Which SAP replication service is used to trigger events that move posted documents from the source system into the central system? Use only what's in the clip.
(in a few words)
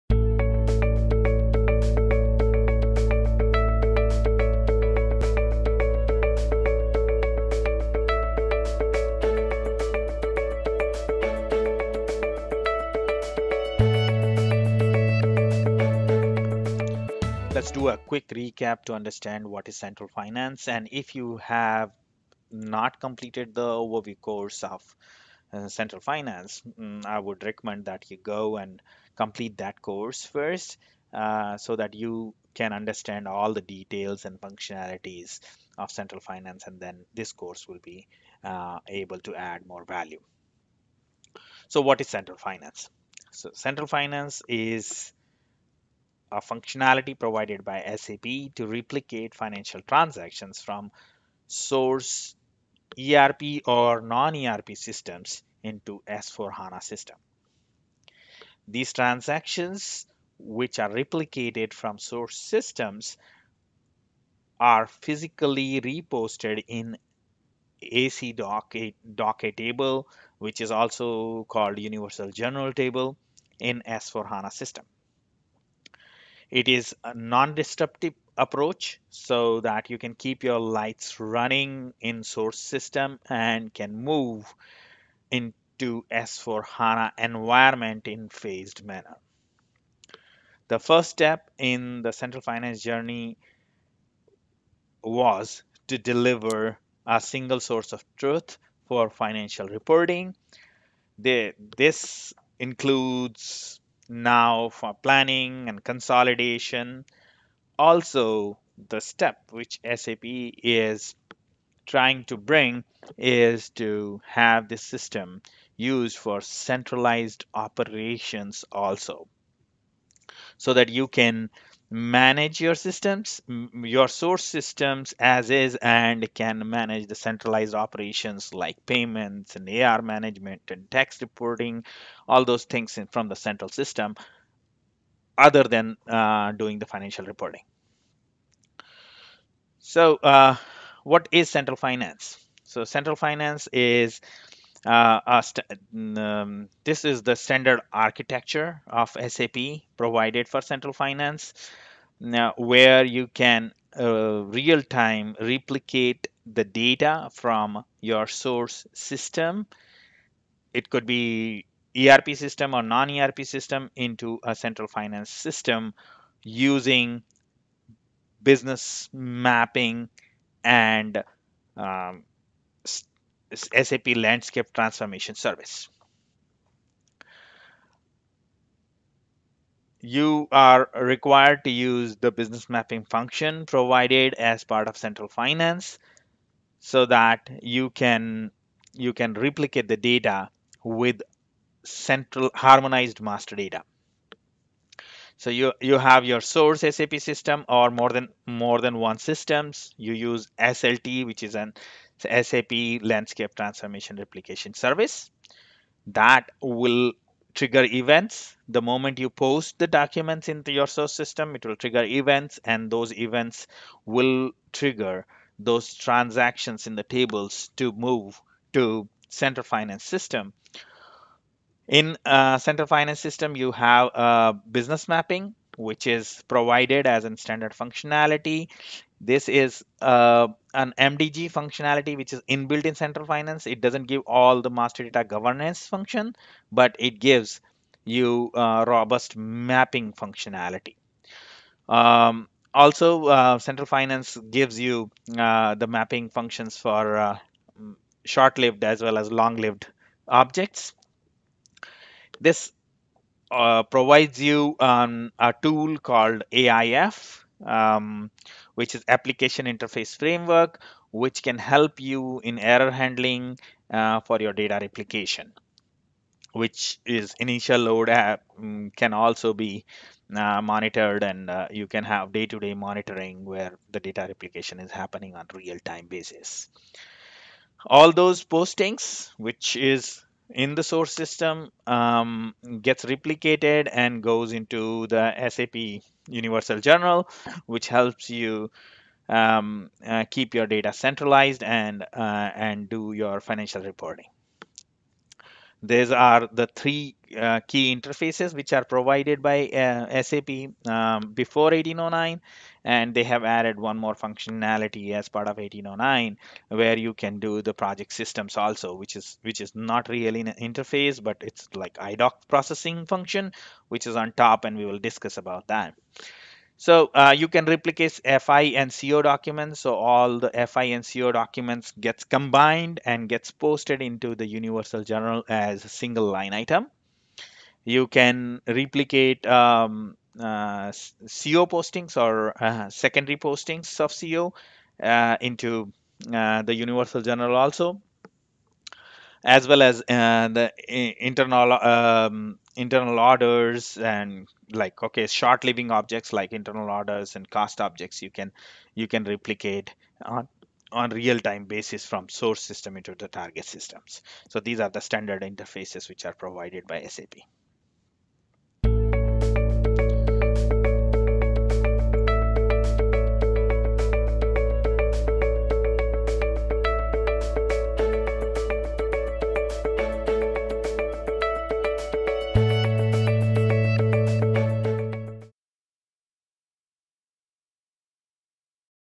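SAP Landscape Transformation Replication Service.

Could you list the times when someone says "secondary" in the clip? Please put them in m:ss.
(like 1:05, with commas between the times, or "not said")
5:32.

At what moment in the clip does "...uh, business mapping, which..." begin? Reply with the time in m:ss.
3:44.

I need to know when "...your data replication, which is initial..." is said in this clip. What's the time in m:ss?
4:24.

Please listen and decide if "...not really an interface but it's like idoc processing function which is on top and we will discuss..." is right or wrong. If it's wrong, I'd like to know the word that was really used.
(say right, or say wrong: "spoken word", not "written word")
right.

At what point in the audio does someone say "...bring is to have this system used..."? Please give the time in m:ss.
1:52.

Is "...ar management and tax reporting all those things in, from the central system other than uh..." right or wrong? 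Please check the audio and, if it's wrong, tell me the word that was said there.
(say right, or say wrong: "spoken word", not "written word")
right.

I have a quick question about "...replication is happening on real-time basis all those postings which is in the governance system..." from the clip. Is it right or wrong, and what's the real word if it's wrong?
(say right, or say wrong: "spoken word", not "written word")
wrong: "source", not "governance".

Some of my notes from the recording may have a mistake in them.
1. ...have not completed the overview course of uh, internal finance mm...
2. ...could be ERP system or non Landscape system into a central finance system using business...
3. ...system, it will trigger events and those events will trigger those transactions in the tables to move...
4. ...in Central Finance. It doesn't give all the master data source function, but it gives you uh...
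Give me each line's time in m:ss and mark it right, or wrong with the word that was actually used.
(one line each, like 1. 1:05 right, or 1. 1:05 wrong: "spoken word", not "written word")
1. 0:21 wrong: "central", not "internal"
2. 2:40 wrong: "ERP", not "Landscape"
3. 3:31 right
4. 3:52 wrong: "governance", not "source".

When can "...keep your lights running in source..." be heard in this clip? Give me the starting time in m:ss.
1:20.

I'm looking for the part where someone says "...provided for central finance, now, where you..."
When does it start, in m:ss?
2:29.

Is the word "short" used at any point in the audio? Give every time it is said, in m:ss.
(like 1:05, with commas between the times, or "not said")
4:08, 5:45.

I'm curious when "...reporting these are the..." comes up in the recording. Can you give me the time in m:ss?
4:53.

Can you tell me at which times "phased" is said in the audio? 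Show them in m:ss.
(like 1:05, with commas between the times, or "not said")
1:28.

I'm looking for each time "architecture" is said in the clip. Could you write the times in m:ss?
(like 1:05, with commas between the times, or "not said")
2:27.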